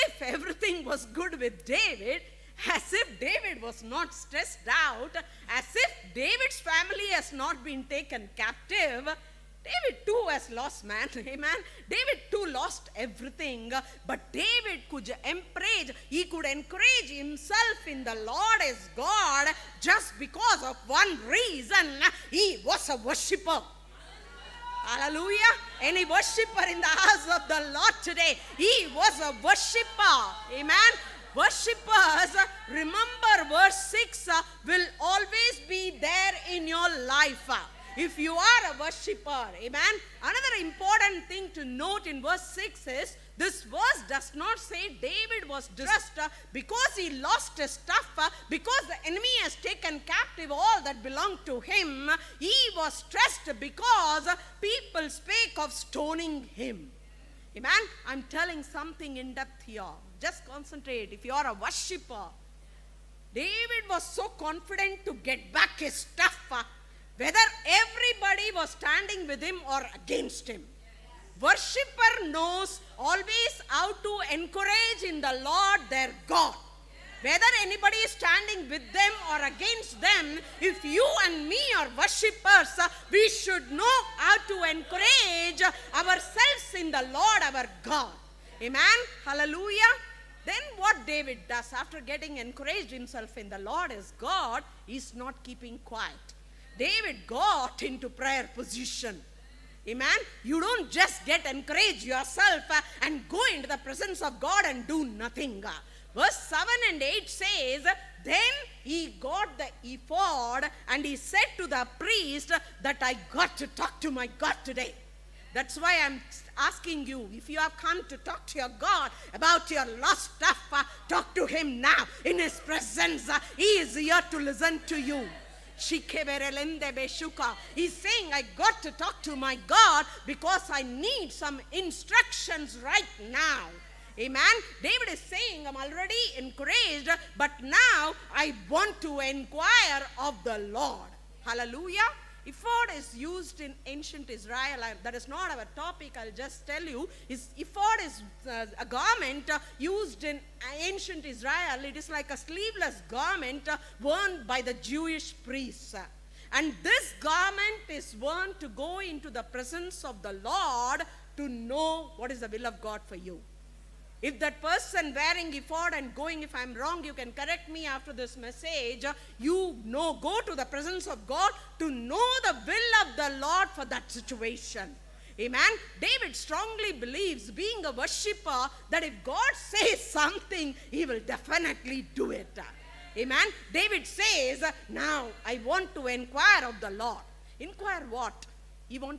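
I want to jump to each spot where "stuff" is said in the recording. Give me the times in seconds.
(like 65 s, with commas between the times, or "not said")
47 s, 65 s, 120 s.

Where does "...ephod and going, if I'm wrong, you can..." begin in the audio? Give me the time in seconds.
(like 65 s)
165 s.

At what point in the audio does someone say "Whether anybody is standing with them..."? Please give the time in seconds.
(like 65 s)
77 s.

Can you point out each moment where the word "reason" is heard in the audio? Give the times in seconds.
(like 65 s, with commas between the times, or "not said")
21 s.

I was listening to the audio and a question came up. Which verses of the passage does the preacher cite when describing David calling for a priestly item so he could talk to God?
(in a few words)
Verse 7 and 8.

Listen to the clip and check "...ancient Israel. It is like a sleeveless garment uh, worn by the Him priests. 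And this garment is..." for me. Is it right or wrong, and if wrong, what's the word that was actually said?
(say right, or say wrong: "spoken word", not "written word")
wrong: "Jewish", not "Him".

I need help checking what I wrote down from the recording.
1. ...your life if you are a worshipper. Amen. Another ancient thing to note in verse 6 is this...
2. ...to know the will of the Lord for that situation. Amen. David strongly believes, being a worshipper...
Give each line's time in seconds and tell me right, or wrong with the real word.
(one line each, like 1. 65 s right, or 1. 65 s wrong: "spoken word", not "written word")
1. 36 s wrong: "important", not "ancient"
2. 171 s right.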